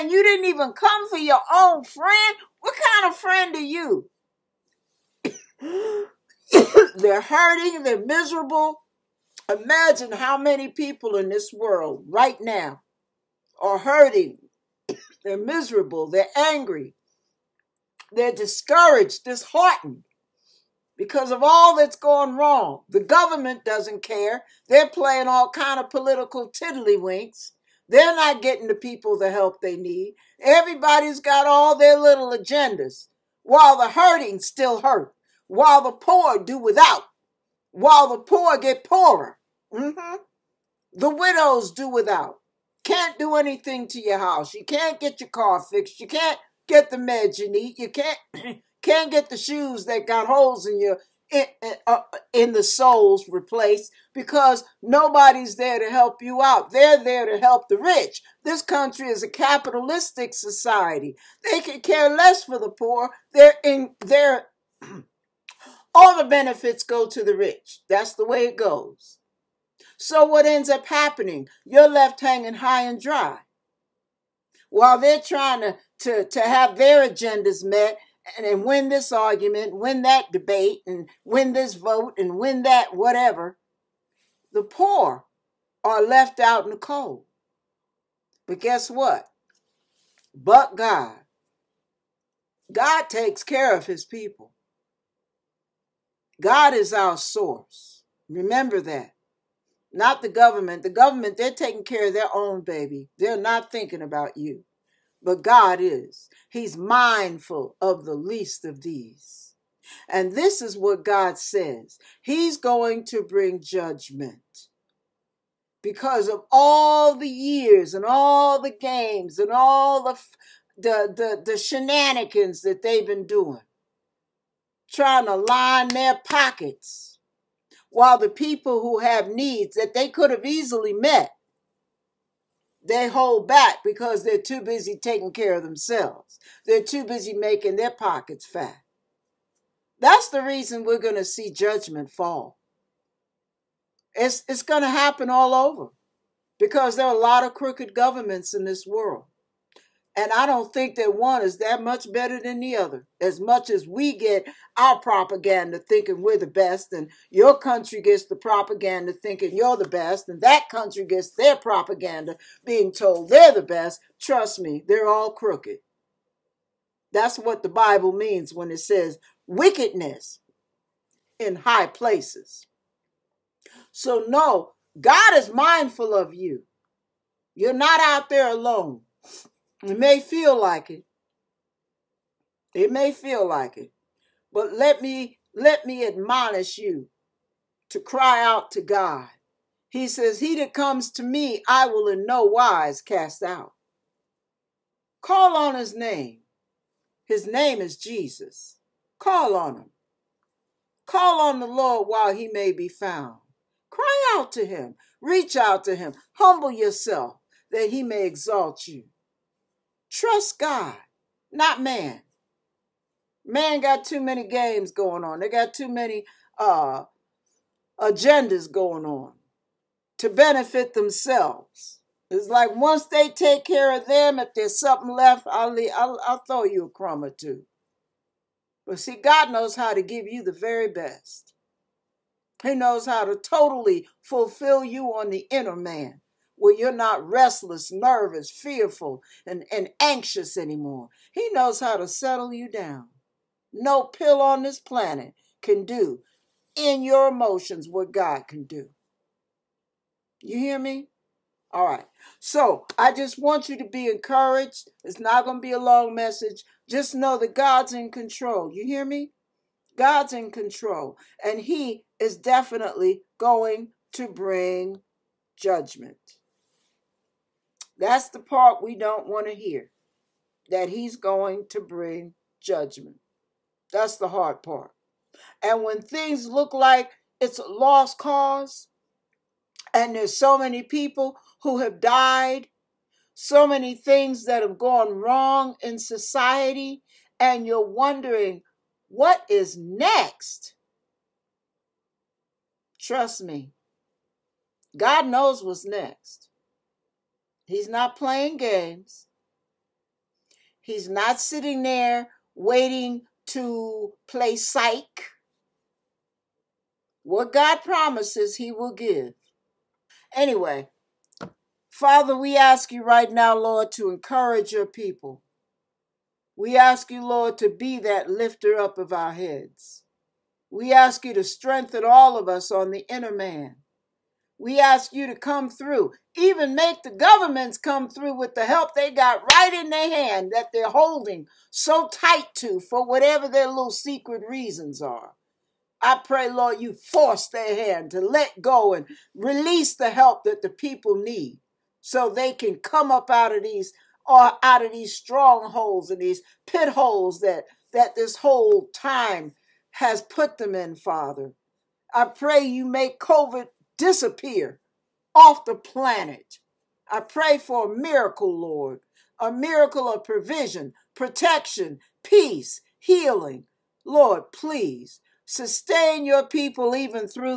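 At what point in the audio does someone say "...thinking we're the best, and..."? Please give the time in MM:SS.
02:35.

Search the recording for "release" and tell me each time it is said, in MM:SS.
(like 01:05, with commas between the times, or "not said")
05:39.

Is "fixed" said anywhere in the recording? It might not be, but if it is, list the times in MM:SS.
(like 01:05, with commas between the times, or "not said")
00:45.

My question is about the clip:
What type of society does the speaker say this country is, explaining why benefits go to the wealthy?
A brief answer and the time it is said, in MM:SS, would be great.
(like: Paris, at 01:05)
capitalistic society, at 00:59.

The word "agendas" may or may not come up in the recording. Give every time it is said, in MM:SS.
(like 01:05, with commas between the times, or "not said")
00:32, 01:17, 03:37.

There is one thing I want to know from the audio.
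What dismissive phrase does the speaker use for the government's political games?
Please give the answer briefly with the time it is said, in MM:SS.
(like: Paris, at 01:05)
political tiddlywinks, at 00:25.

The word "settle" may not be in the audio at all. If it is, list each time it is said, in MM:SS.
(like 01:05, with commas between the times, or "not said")
04:02.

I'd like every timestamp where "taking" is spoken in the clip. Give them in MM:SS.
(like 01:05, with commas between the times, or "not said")
01:41, 02:14.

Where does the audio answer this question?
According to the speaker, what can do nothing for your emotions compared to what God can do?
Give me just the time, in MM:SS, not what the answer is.
04:04.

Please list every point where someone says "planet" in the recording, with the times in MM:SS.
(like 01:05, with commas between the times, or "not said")
04:04, 05:55.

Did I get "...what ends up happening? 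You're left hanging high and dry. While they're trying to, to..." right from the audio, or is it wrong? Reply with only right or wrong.
right.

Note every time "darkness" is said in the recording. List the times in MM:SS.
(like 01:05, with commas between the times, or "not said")
not said.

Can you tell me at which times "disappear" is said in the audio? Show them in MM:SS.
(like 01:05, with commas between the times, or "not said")
05:53.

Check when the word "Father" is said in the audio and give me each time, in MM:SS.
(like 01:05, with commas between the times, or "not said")
05:11, 05:50.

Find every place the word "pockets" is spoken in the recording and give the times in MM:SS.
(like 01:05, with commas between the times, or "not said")
02:06, 02:17.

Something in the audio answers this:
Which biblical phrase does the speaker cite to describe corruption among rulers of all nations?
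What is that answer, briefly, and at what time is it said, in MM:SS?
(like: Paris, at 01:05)
wickedness in high places, at 02:49.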